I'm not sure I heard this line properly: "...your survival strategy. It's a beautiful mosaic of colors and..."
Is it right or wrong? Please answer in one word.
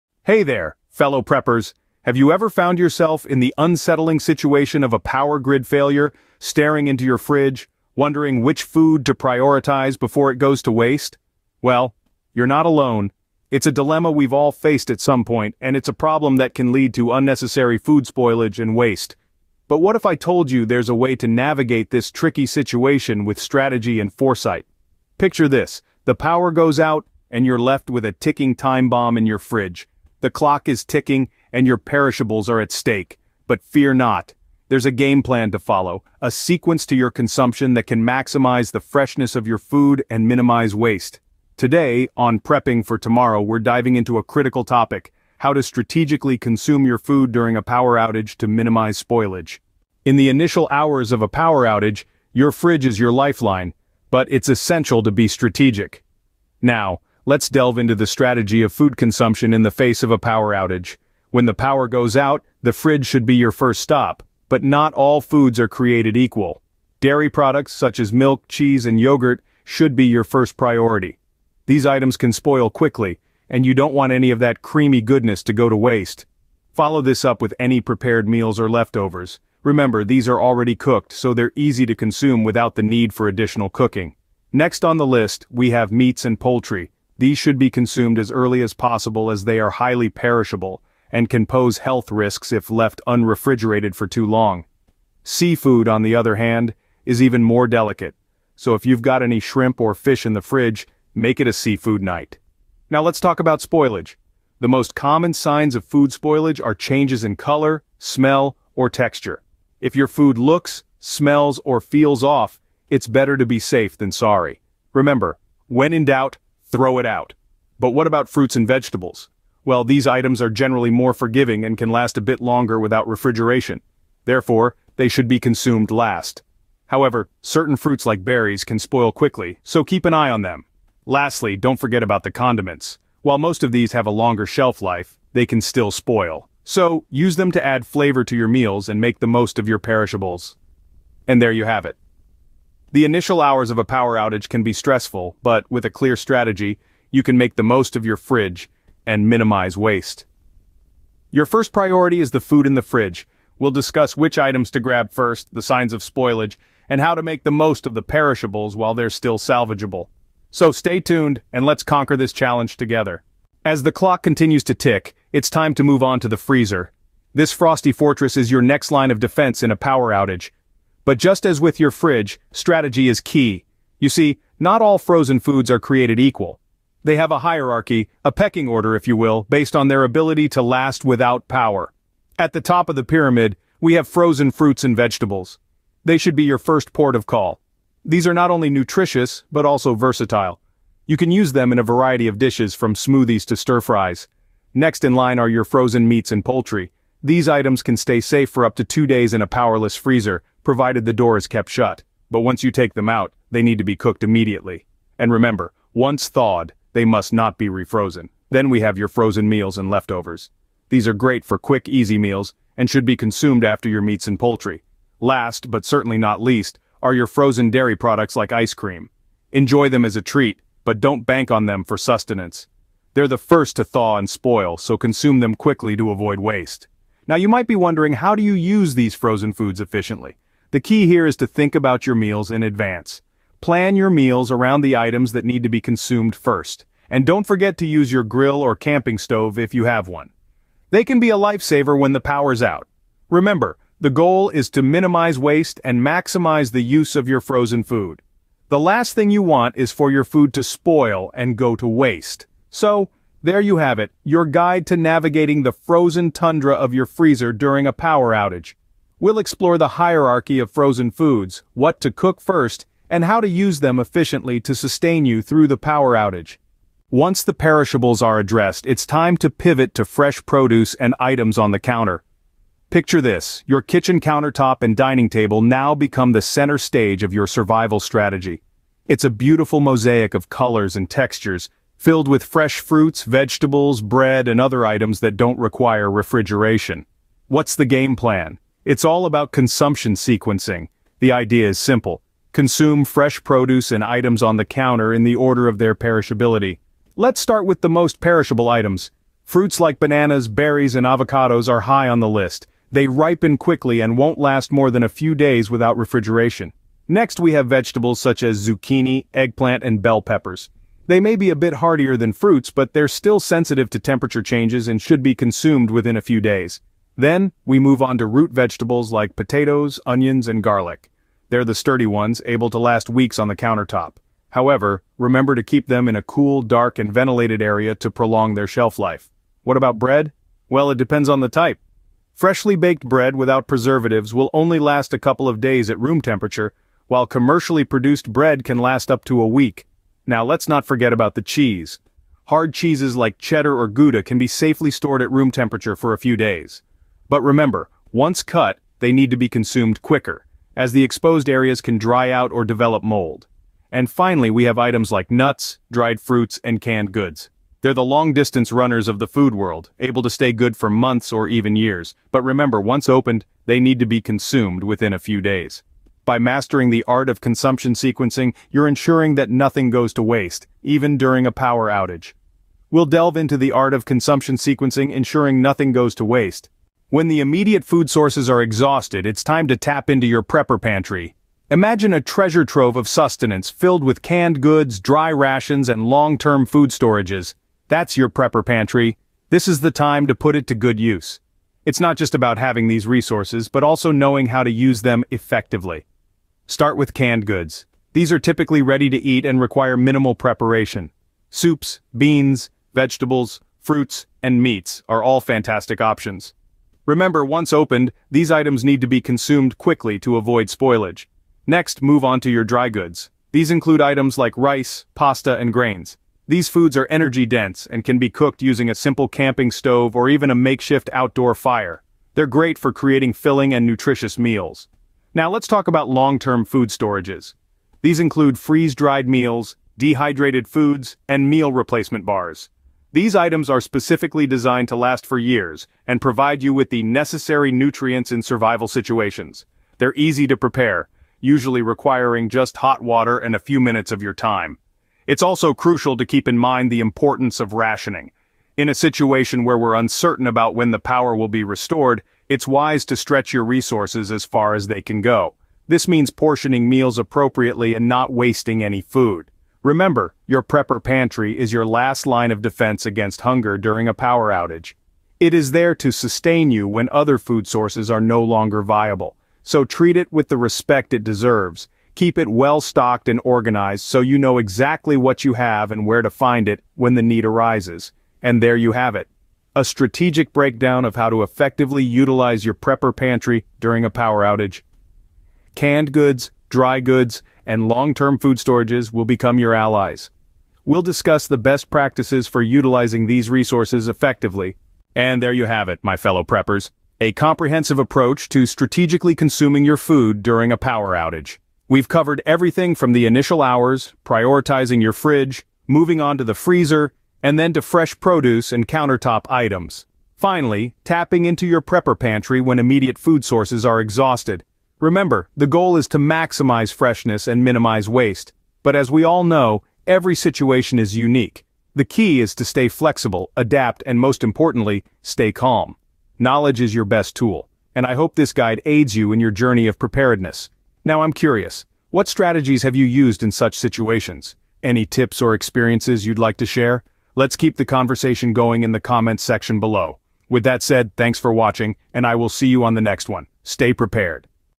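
right.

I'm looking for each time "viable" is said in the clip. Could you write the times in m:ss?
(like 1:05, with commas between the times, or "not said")
7:48.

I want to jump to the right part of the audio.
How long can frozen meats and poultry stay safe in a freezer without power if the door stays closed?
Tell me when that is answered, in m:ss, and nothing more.
3:18.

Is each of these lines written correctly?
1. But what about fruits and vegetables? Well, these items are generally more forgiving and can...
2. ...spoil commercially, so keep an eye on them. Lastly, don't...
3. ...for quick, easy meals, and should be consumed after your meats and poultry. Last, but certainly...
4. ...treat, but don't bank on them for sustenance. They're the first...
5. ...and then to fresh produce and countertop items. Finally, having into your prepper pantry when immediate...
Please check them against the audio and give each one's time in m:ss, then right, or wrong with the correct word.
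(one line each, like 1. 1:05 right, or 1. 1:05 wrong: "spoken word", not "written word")
1. 1:57 right
2. 2:08 wrong: "quickly", not "commercially"
3. 3:31 right
4. 3:40 right
5. 8:27 wrong: "tapping", not "having".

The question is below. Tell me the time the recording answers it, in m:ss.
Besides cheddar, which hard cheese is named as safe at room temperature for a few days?
5:43.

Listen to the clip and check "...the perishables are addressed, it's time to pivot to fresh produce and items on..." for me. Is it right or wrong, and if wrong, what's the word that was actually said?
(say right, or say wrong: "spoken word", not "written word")
right.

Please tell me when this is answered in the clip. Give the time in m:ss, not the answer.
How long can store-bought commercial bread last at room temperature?
5:39.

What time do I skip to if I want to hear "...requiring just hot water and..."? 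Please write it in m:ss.
7:21.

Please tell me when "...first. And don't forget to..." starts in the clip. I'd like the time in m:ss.
3:56.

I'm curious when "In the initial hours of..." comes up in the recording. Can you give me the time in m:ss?
0:50.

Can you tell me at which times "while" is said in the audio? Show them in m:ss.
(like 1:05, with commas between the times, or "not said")
2:13, 2:38, 5:37.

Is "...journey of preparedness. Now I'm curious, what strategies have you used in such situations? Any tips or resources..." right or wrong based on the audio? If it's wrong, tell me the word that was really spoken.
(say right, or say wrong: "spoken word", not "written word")
wrong: "experiences", not "resources".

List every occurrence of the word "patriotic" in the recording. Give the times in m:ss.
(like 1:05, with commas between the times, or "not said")
not said.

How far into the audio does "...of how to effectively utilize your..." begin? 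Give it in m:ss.
8:01.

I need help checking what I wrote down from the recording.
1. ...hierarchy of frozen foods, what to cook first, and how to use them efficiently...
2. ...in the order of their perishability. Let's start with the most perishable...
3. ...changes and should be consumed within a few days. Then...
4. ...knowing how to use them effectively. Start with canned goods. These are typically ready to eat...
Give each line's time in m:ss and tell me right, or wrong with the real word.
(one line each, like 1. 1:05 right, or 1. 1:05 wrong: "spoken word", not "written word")
1. 4:20 right
2. 4:55 right
3. 5:14 right
4. 6:34 right.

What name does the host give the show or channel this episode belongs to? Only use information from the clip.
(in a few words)
Prepping for Tomorrow.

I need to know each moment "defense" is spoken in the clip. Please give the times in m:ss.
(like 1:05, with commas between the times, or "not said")
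2:49, 7:42.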